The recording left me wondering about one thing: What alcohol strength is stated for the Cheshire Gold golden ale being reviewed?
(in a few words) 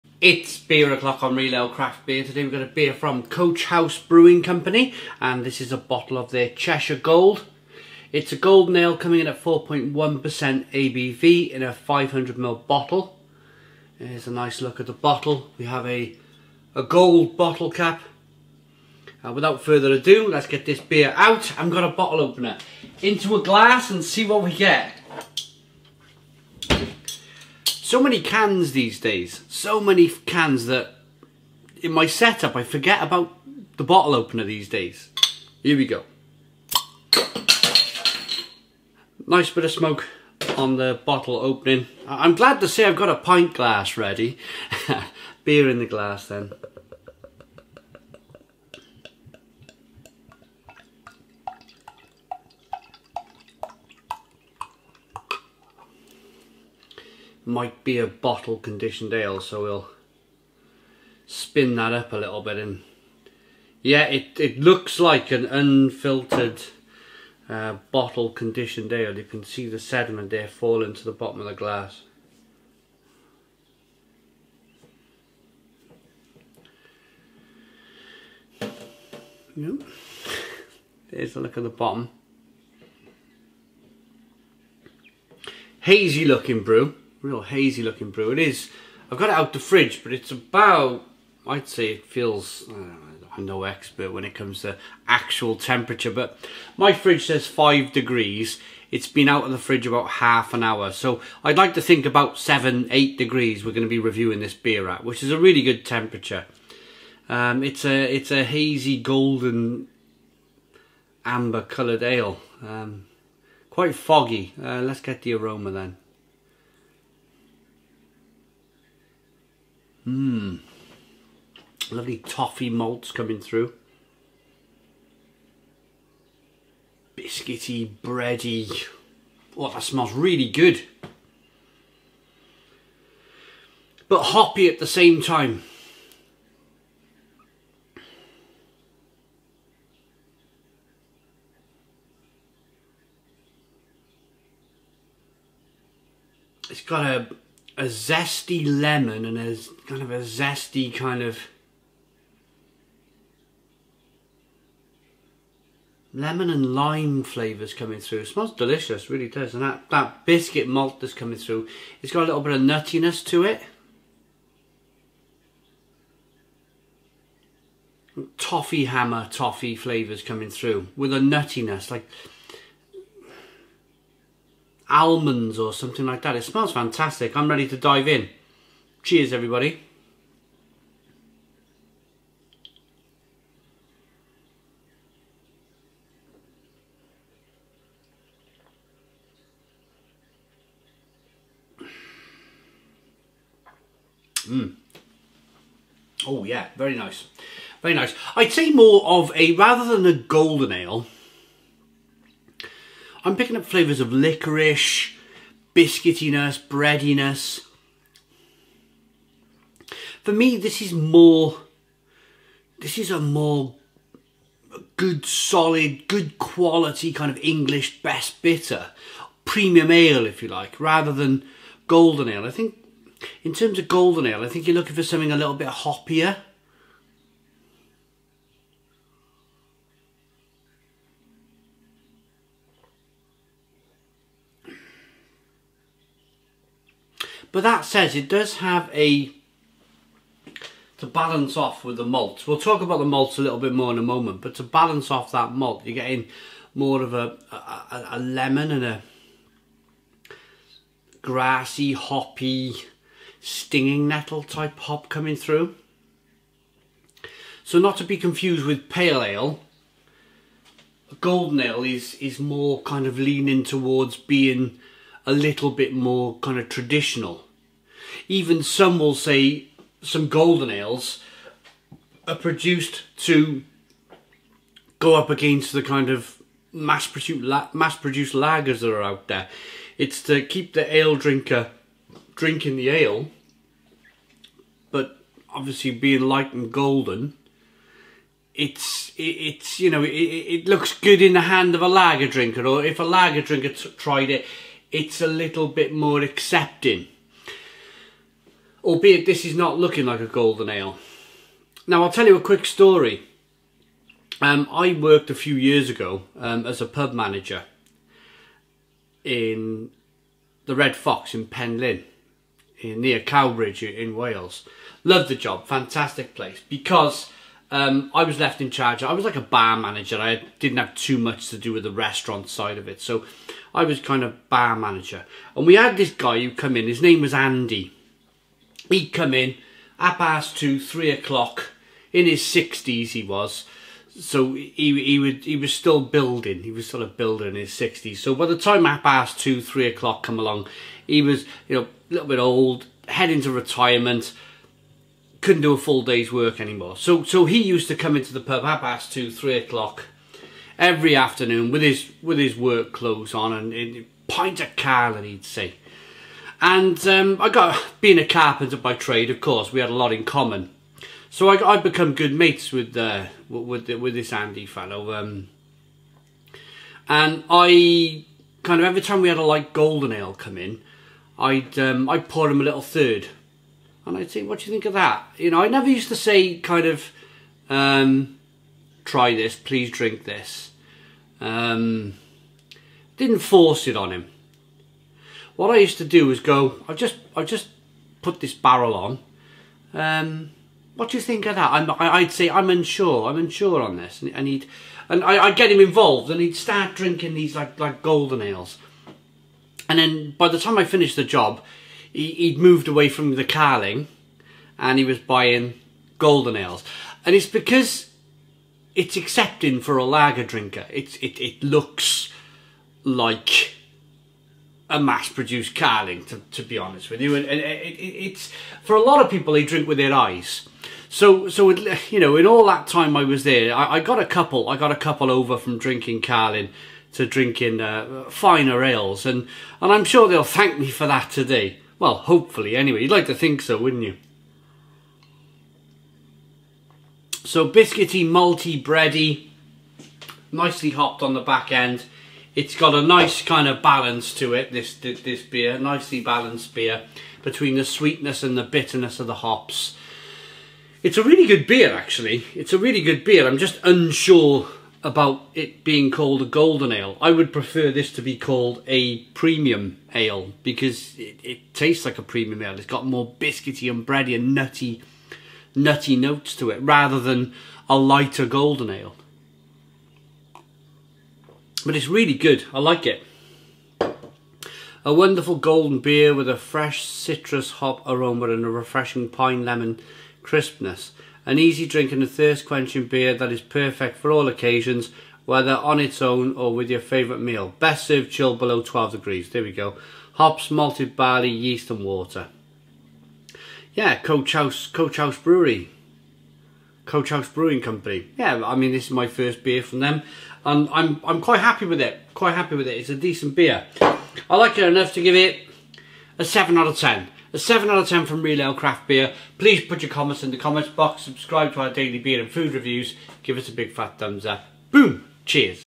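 4.1%.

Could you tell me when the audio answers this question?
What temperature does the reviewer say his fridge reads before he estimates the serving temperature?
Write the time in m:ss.
1:37.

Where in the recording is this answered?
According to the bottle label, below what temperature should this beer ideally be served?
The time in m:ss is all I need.
8:08.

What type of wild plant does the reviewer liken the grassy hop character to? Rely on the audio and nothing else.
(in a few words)
Stinging nettle.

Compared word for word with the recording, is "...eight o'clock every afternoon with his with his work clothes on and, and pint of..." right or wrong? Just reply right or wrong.
wrong.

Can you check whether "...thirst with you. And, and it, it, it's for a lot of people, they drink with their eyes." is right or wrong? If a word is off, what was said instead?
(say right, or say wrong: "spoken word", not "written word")
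wrong: "honest", not "thirst".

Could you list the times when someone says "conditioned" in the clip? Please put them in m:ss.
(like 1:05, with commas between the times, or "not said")
0:58, 1:08.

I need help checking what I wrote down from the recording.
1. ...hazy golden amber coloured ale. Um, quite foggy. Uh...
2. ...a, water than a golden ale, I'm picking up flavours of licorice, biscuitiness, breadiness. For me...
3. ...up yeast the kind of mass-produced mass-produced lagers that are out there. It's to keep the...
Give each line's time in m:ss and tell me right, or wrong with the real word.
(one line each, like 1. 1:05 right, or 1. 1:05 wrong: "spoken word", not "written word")
1. 1:48 right
2. 3:19 wrong: "rather", not "water"
3. 4:35 wrong: "against", not "yeast".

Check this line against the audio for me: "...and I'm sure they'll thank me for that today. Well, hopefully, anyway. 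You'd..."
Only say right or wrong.
right.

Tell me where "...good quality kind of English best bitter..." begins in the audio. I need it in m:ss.
3:36.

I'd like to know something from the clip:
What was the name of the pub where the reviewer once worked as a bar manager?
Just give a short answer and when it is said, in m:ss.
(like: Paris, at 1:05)
Red Fox, at 5:10.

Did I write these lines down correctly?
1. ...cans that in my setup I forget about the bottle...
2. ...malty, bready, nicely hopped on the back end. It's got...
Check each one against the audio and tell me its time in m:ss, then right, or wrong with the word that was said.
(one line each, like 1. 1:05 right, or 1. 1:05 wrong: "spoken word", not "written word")
1. 0:30 right
2. 7:18 right.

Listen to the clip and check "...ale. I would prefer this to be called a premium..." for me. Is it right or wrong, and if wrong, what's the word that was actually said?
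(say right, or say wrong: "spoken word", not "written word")
right.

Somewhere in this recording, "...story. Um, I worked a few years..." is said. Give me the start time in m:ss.
5:02.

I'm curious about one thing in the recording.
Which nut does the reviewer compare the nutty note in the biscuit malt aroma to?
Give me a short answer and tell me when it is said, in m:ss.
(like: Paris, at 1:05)
Almonds, at 2:54.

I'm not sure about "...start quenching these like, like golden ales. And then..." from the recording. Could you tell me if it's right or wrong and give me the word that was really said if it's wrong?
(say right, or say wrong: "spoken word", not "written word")
wrong: "drinking", not "quenching".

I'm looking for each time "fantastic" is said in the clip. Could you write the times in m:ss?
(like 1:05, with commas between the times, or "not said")
2:56, 5:15.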